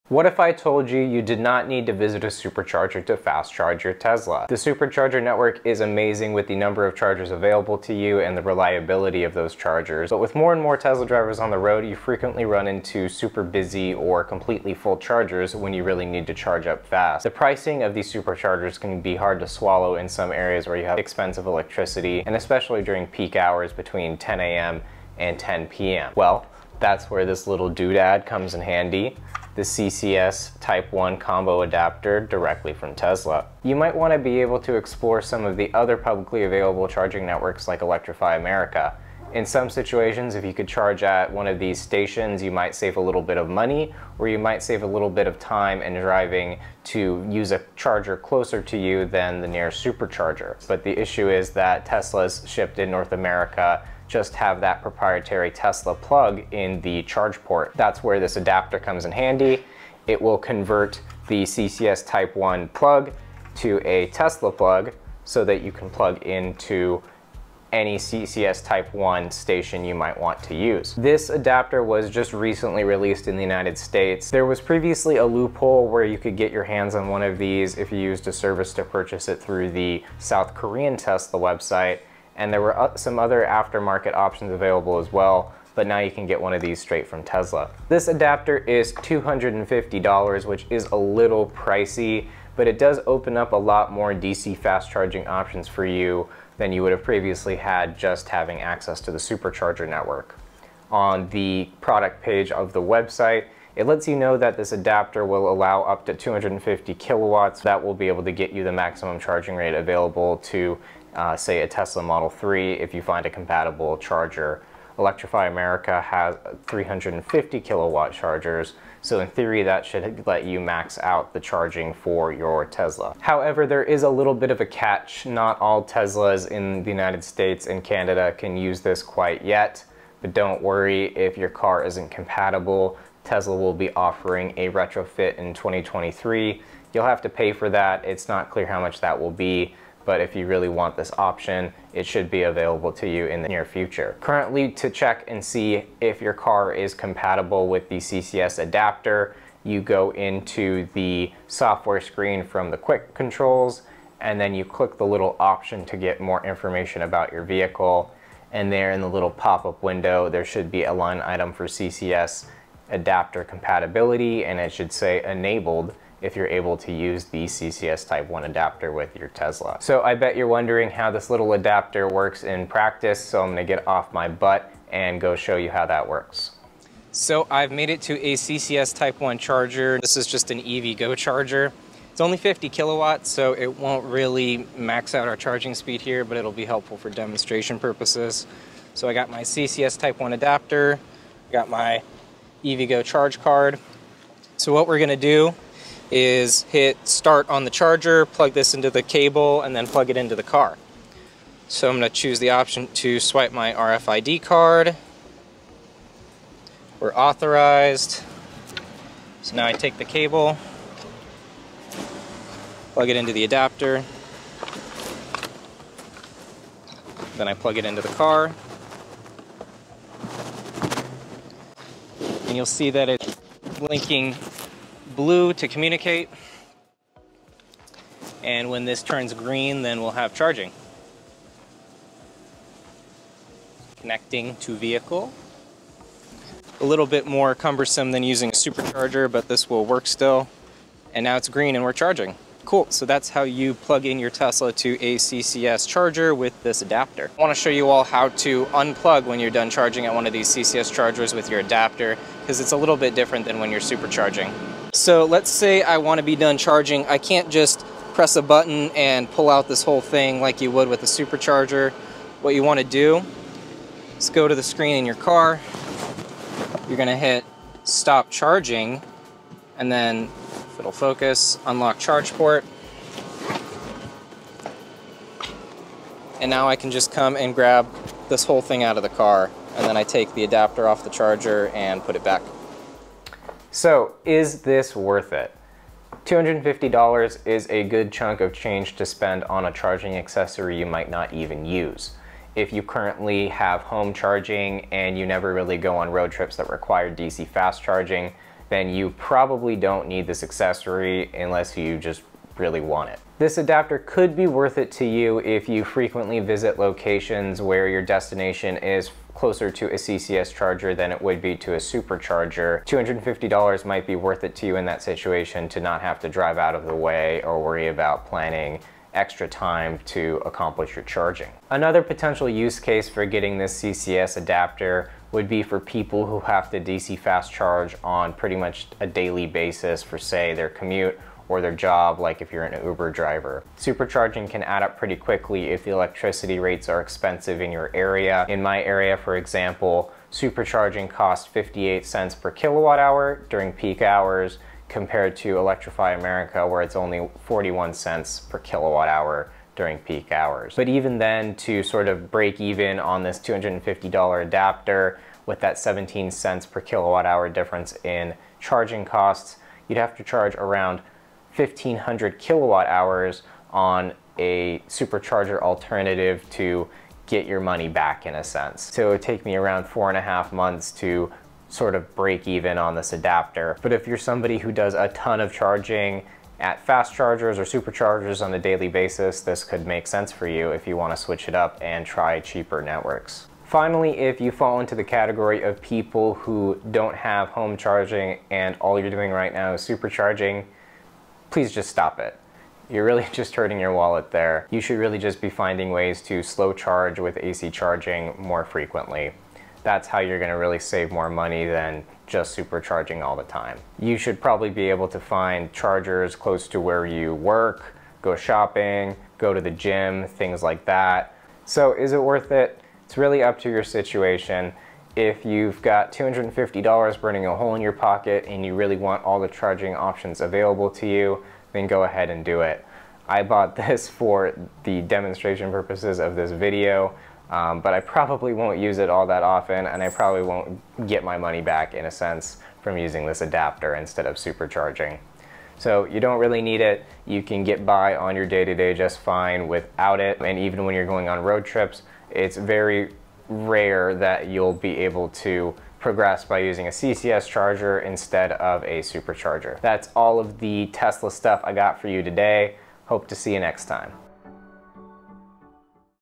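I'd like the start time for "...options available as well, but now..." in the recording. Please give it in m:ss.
1:24.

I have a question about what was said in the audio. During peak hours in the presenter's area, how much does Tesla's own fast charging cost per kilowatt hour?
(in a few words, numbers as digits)
58 cents.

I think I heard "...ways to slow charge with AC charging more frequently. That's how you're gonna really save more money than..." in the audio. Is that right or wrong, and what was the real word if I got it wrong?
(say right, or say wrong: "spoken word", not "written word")
right.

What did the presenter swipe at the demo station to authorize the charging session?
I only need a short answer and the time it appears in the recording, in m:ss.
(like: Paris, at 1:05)
RFID card, at 3:23.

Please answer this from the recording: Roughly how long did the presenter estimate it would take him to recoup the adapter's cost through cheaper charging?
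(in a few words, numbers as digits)
4.5 months.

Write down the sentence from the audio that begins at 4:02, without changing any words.
Cool, so that's how you plug in your Tesla to a CCS charger with this adapter.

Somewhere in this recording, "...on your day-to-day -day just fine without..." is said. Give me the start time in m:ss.
7:18.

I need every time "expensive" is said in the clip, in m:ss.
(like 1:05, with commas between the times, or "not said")
0:20, 5:37.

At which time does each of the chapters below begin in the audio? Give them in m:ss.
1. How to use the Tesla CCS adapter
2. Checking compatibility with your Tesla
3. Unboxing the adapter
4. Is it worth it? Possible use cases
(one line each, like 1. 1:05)
1. 2:50
2. 2:02
3. 1:13
4. 4:43.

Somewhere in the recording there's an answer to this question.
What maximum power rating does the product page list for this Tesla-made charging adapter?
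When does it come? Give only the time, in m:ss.
1:45.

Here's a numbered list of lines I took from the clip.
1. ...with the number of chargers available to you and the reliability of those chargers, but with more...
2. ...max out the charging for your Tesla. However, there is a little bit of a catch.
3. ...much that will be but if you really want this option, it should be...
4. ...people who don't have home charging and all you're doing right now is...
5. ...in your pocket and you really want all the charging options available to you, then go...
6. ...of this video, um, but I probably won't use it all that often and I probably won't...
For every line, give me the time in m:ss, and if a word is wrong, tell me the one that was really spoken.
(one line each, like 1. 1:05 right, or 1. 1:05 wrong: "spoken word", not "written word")
1. 0:06 right
2. 2:00 right
3. 2:18 right
4. 6:25 right
5. 6:57 right
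6. 7:06 right.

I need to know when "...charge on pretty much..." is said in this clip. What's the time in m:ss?
5:27.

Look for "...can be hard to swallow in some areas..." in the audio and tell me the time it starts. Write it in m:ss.
0:18.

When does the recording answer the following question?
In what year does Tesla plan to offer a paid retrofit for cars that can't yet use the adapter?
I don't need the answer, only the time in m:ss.
2:15.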